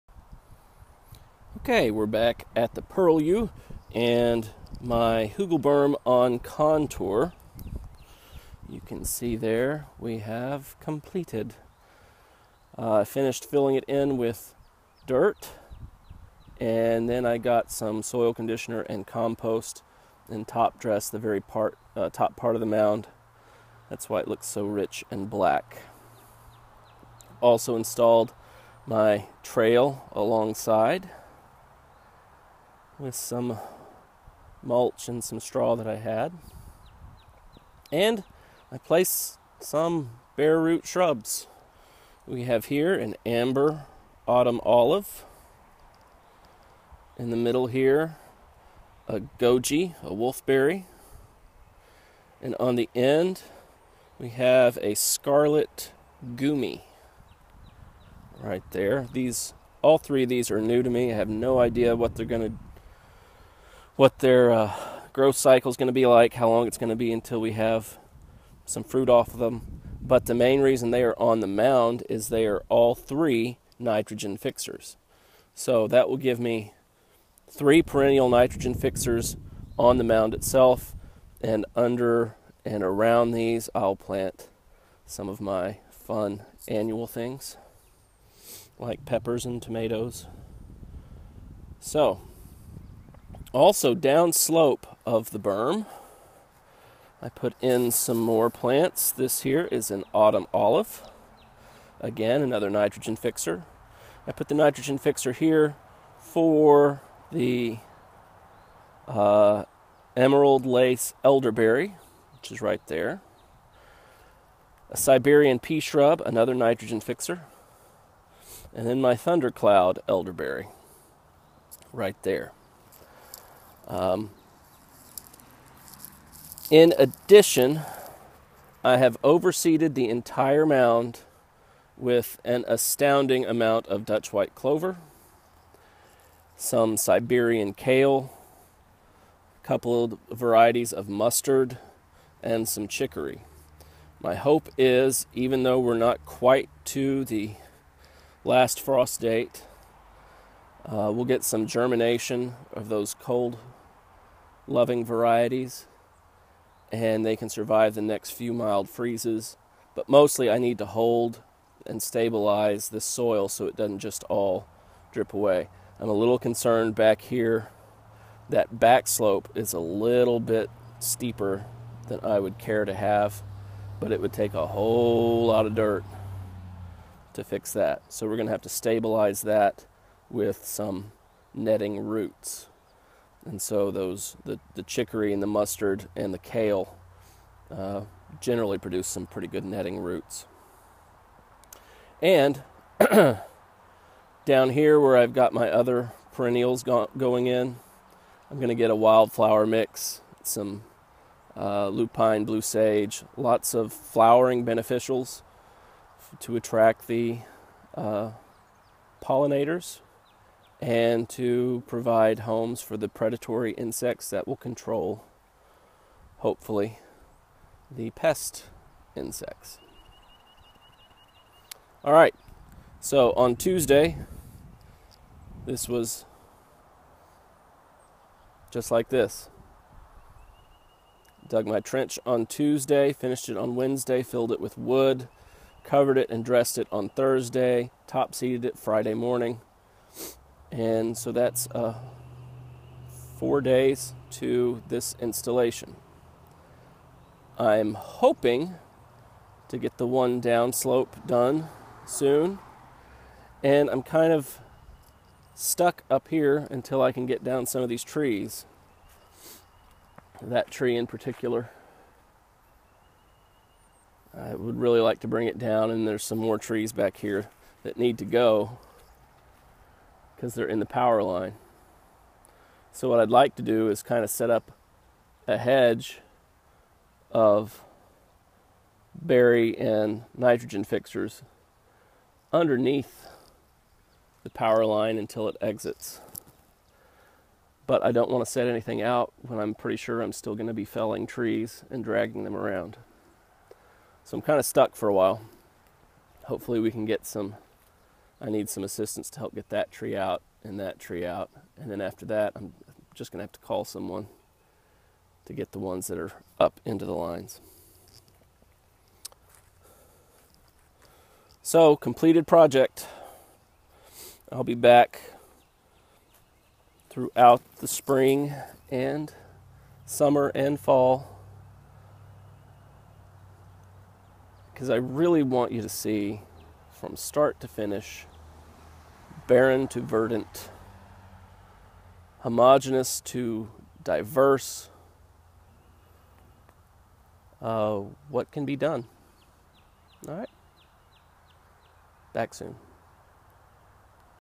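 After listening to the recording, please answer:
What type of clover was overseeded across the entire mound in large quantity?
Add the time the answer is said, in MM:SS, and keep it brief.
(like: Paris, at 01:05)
Dutch white clover, at 02:14.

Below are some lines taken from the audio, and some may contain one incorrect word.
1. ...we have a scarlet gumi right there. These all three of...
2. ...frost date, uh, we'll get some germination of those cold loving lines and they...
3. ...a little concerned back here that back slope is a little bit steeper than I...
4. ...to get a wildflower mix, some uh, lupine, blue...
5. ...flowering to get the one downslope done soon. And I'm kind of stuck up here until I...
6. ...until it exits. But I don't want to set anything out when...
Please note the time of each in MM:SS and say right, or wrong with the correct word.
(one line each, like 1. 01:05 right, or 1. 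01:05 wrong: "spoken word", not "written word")
1. 00:54 right
2. 02:28 wrong: "varieties", not "lines"
3. 02:46 right
4. 03:18 right
5. 04:07 wrong: "hoping", not "flowering"
6. 04:45 right.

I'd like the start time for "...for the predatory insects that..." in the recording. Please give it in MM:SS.
03:32.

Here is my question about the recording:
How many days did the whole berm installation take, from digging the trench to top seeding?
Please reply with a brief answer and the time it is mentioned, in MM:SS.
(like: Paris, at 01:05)
4, at 04:03.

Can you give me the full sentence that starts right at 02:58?
So, we're going to have to stabilize that with some netting roots.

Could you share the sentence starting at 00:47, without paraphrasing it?
In the middle here, a goji, a wolfberry.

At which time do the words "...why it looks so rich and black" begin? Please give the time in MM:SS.
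00:24.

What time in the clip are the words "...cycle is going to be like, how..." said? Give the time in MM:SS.
01:05.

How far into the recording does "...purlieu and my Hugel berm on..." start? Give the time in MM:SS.
00:02.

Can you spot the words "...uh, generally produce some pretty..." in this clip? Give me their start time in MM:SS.
03:07.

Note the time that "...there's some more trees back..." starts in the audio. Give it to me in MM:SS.
04:26.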